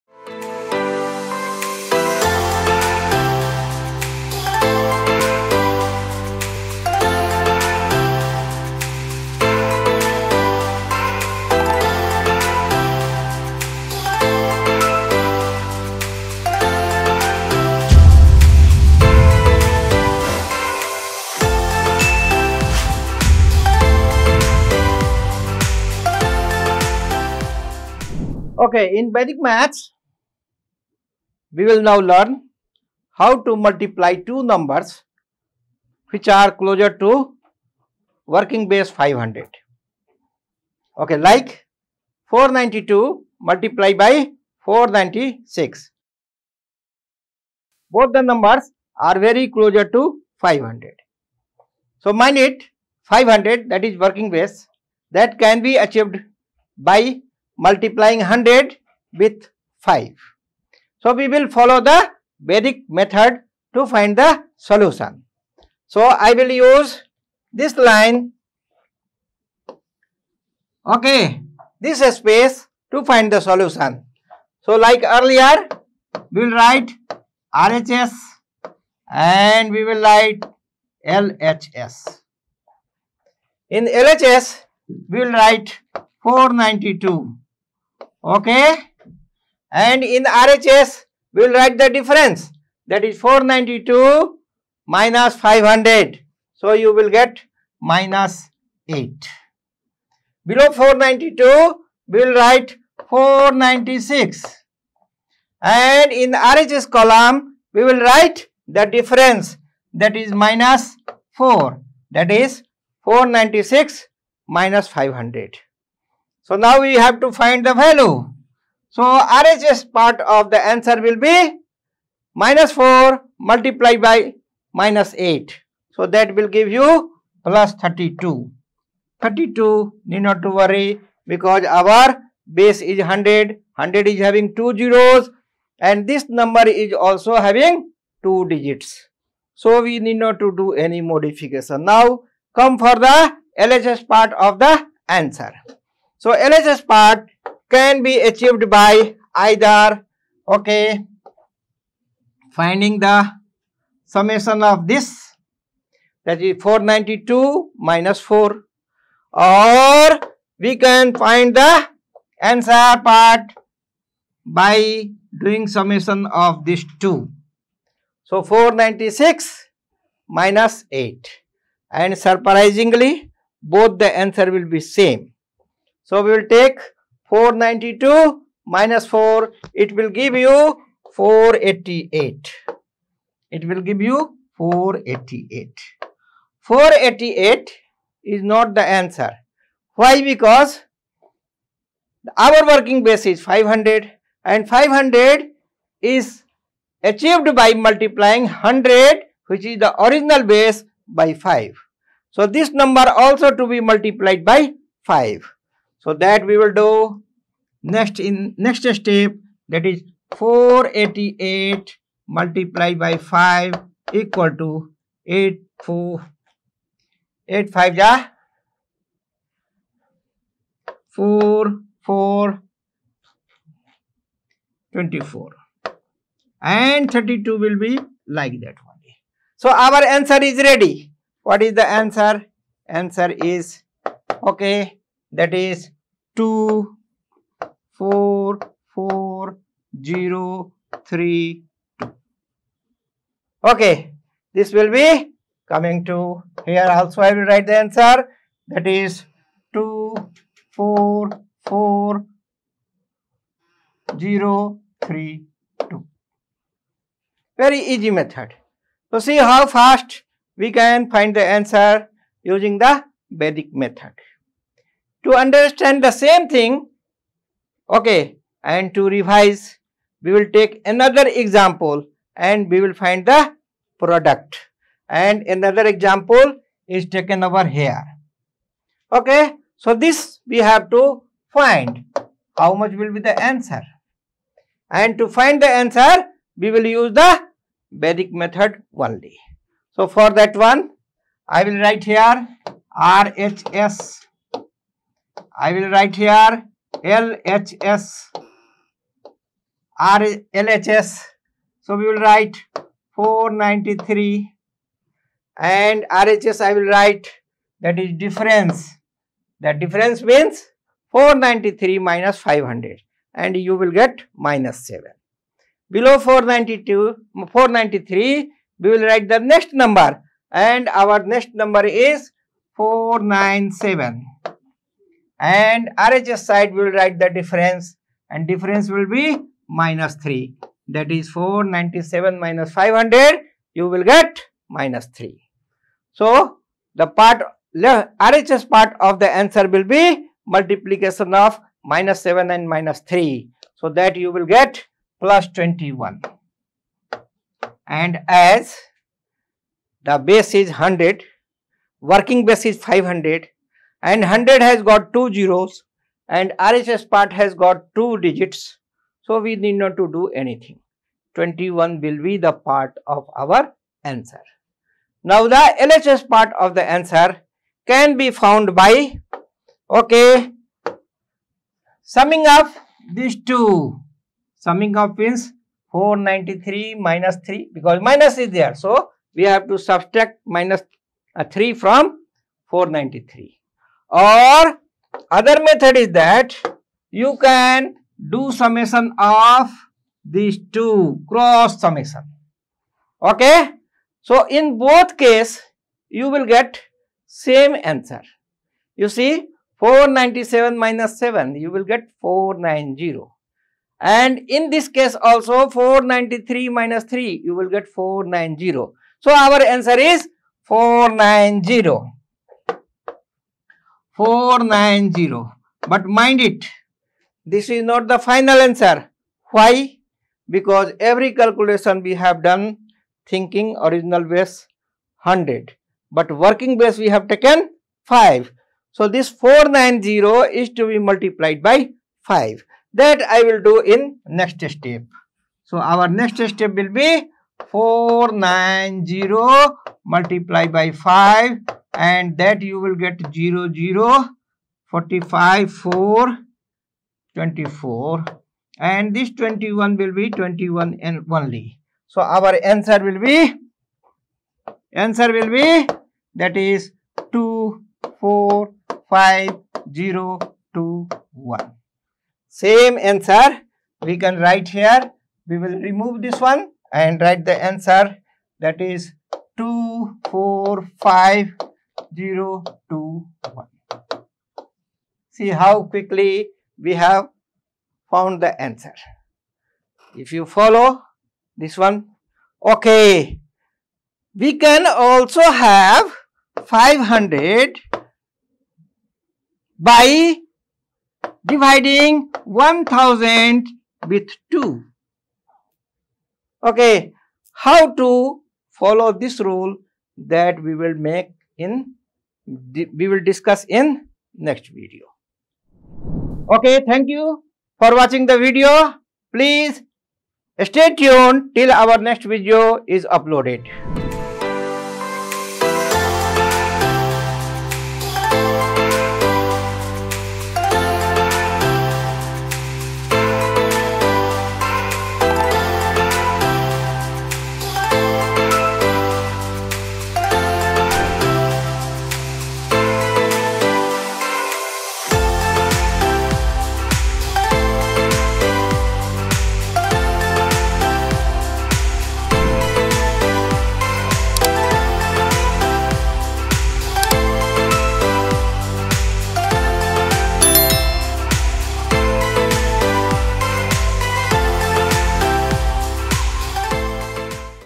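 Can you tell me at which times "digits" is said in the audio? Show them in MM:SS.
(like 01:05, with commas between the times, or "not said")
02:18, 05:58.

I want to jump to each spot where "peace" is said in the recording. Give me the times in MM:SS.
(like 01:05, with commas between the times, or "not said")
not said.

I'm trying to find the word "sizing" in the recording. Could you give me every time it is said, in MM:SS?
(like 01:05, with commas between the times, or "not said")
not said.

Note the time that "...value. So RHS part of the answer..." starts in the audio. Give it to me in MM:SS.
01:57.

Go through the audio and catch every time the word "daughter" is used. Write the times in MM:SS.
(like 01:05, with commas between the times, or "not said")
not said.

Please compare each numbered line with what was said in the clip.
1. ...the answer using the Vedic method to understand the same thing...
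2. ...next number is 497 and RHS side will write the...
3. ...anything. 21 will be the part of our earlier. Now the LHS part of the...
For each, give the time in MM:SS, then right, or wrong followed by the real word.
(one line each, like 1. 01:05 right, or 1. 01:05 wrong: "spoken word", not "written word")
1. 04:21 right
2. 05:21 right
3. 06:00 wrong: "answer", not "earlier".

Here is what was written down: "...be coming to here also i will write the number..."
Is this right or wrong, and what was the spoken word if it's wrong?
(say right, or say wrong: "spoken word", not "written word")
wrong: "answer", not "number".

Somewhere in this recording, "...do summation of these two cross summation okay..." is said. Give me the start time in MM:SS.
06:28.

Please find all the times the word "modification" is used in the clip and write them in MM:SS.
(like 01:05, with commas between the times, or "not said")
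02:20.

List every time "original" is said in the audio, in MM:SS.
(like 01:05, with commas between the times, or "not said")
03:20, 07:03.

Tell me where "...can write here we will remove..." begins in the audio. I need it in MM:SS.
07:44.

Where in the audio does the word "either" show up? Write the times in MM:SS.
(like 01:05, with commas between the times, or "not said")
02:29.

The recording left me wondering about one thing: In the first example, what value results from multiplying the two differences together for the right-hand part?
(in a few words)
plus 32.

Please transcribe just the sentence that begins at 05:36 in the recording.
So, the part RHS part of the answer will be multiplication of minus 7 and minus 3.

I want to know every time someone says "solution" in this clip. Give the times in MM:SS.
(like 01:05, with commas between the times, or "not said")
01:04, 01:13.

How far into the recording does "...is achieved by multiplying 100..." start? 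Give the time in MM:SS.
03:16.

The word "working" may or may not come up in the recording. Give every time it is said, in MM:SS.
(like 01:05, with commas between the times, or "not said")
00:38, 00:53, 03:12, 05:52, 07:06.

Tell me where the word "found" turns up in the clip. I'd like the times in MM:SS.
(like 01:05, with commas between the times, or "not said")
06:08, 07:58.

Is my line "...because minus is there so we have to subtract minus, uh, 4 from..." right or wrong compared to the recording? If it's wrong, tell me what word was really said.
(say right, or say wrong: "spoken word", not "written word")
wrong: "3", not "4".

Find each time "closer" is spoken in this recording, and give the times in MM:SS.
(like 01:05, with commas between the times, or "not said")
00:36, 00:49.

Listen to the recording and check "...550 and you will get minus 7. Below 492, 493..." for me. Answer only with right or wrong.
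wrong.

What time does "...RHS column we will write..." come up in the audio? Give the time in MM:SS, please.
01:46.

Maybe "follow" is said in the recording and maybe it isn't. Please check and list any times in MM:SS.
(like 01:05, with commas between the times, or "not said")
01:01, 08:00, 08:18.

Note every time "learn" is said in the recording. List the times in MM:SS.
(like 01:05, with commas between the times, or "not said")
00:31.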